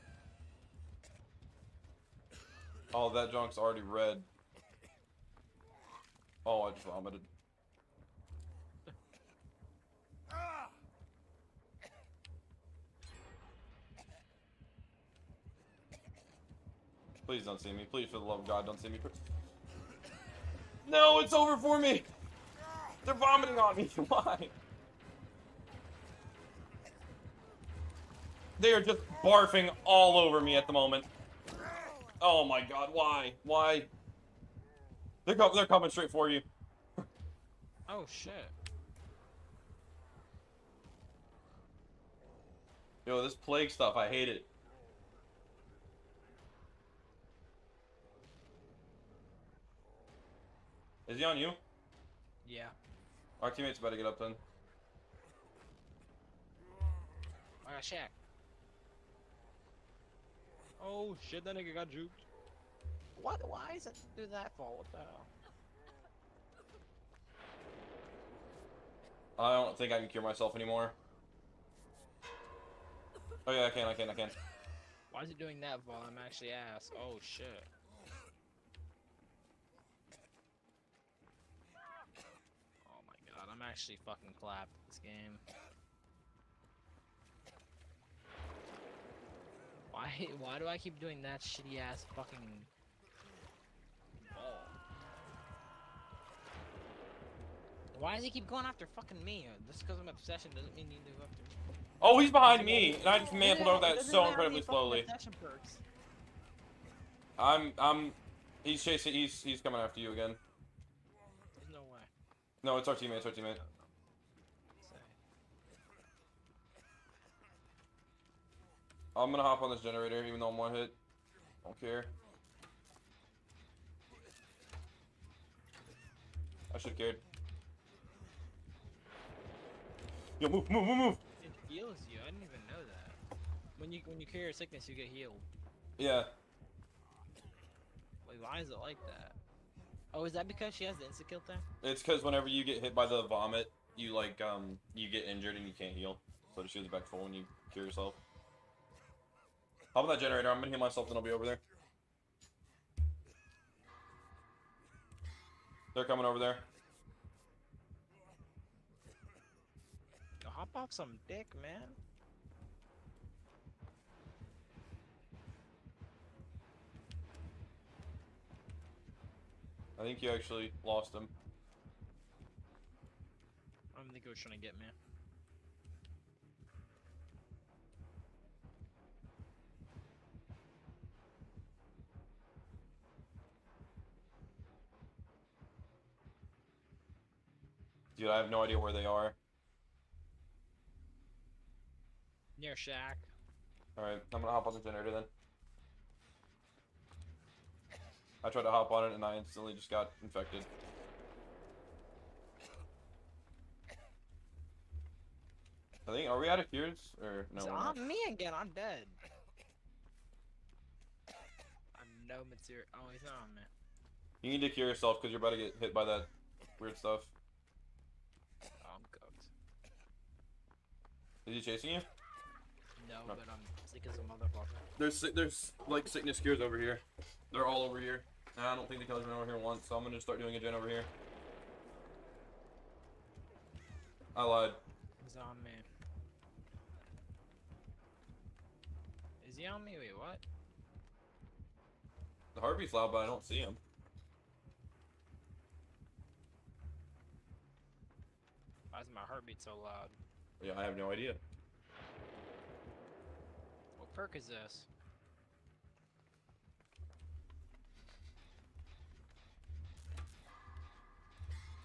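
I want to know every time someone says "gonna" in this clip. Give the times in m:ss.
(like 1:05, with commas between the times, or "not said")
1:59, 2:30, 3:14, 3:50.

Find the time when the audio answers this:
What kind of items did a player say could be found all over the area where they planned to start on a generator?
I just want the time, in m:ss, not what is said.
3:46.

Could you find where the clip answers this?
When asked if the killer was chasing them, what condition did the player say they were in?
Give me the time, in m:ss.
3:43.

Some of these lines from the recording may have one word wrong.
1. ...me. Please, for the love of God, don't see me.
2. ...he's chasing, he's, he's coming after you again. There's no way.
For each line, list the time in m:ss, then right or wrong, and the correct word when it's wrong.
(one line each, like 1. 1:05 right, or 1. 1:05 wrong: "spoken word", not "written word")
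1. 0:17 right
2. 1:48 right.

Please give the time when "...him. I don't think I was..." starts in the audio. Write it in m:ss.
2:51.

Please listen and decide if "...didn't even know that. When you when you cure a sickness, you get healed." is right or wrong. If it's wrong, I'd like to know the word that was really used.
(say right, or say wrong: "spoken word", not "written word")
right.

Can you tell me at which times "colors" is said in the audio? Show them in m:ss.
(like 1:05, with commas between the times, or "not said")
3:49.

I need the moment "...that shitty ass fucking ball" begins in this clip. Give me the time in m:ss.
1:31.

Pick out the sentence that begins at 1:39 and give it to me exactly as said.
Just uh, because I'm obsession doesn't mean you need to go after me.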